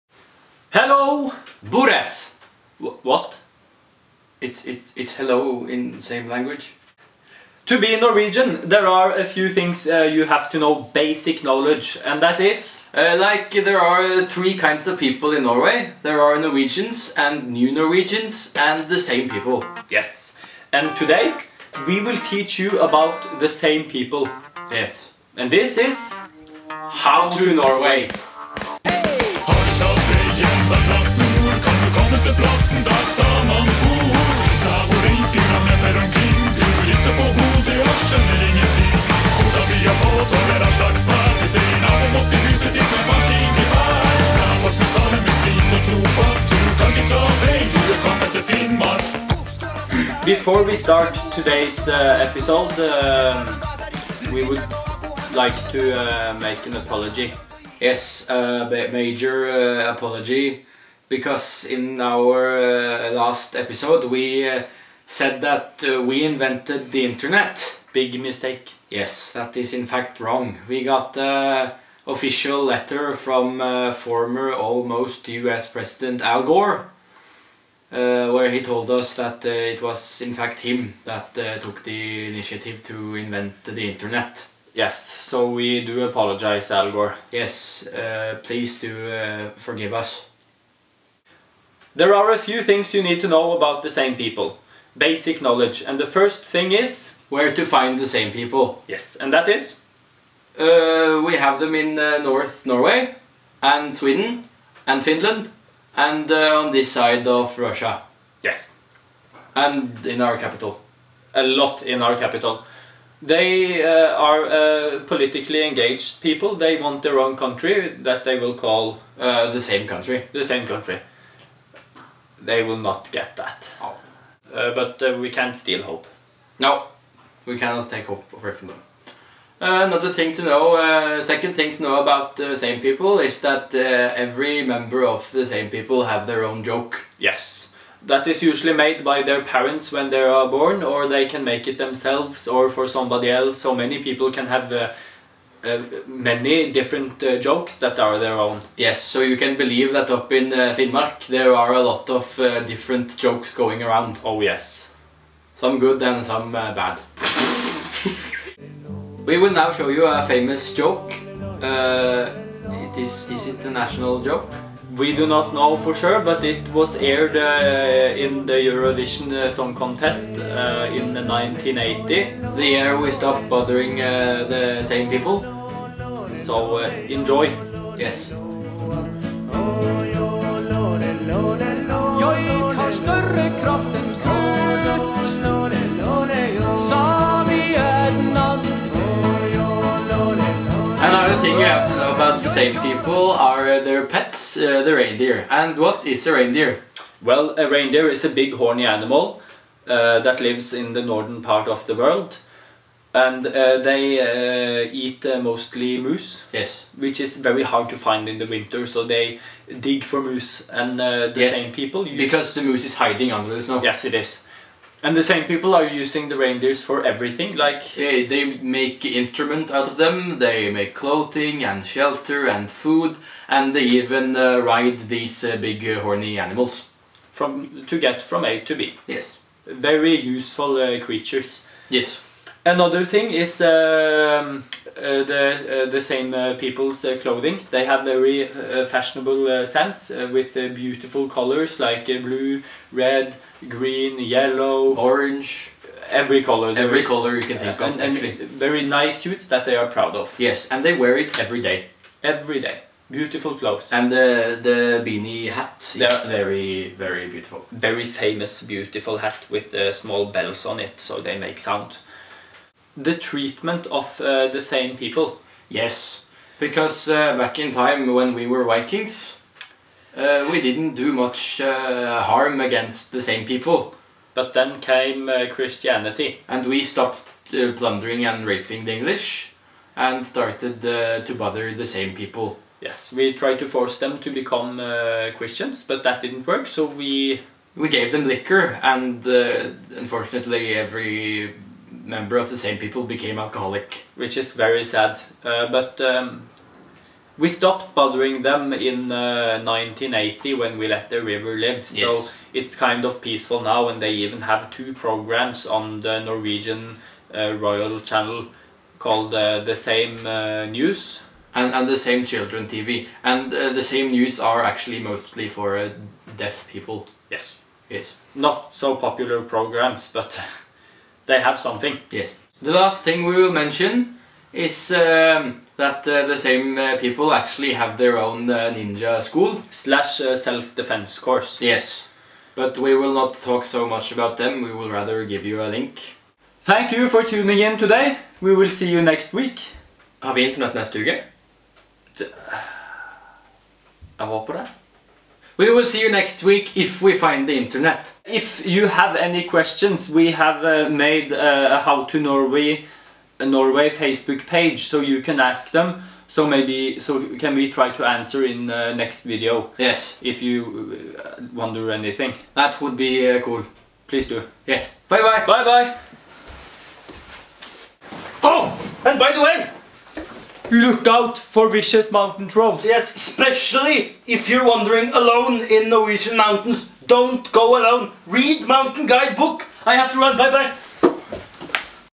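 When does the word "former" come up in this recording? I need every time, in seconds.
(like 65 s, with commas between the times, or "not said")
73 s.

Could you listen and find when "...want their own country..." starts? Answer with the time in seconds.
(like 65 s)
116 s.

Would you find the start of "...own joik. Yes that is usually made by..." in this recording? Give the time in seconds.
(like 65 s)
136 s.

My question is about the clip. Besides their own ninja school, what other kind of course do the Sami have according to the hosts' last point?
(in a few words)
self-defense course.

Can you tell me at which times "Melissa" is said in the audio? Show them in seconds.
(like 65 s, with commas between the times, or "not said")
not said.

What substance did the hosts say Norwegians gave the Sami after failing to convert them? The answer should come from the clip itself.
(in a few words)
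liquor.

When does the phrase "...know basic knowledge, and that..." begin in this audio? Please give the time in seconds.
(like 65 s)
10 s.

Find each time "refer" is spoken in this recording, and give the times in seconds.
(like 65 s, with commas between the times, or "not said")
not said.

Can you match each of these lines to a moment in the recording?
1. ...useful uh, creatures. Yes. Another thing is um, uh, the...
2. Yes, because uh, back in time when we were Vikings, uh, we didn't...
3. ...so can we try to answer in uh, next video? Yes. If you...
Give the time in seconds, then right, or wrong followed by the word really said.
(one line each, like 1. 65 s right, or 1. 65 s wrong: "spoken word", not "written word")
1. 230 s right
2. 265 s right
3. 356 s right.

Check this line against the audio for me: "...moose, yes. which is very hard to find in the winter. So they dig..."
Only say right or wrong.
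right.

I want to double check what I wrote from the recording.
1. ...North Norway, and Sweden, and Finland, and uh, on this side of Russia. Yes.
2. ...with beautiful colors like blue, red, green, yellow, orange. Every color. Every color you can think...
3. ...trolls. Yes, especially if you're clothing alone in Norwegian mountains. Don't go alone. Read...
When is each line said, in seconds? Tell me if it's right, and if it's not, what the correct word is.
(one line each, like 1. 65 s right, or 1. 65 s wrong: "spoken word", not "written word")
1. 102 s right
2. 240 s right
3. 372 s wrong: "wandering", not "clothing".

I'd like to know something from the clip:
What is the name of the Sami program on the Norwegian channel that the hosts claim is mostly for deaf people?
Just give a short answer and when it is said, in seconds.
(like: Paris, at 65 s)
The Same News, at 309 s.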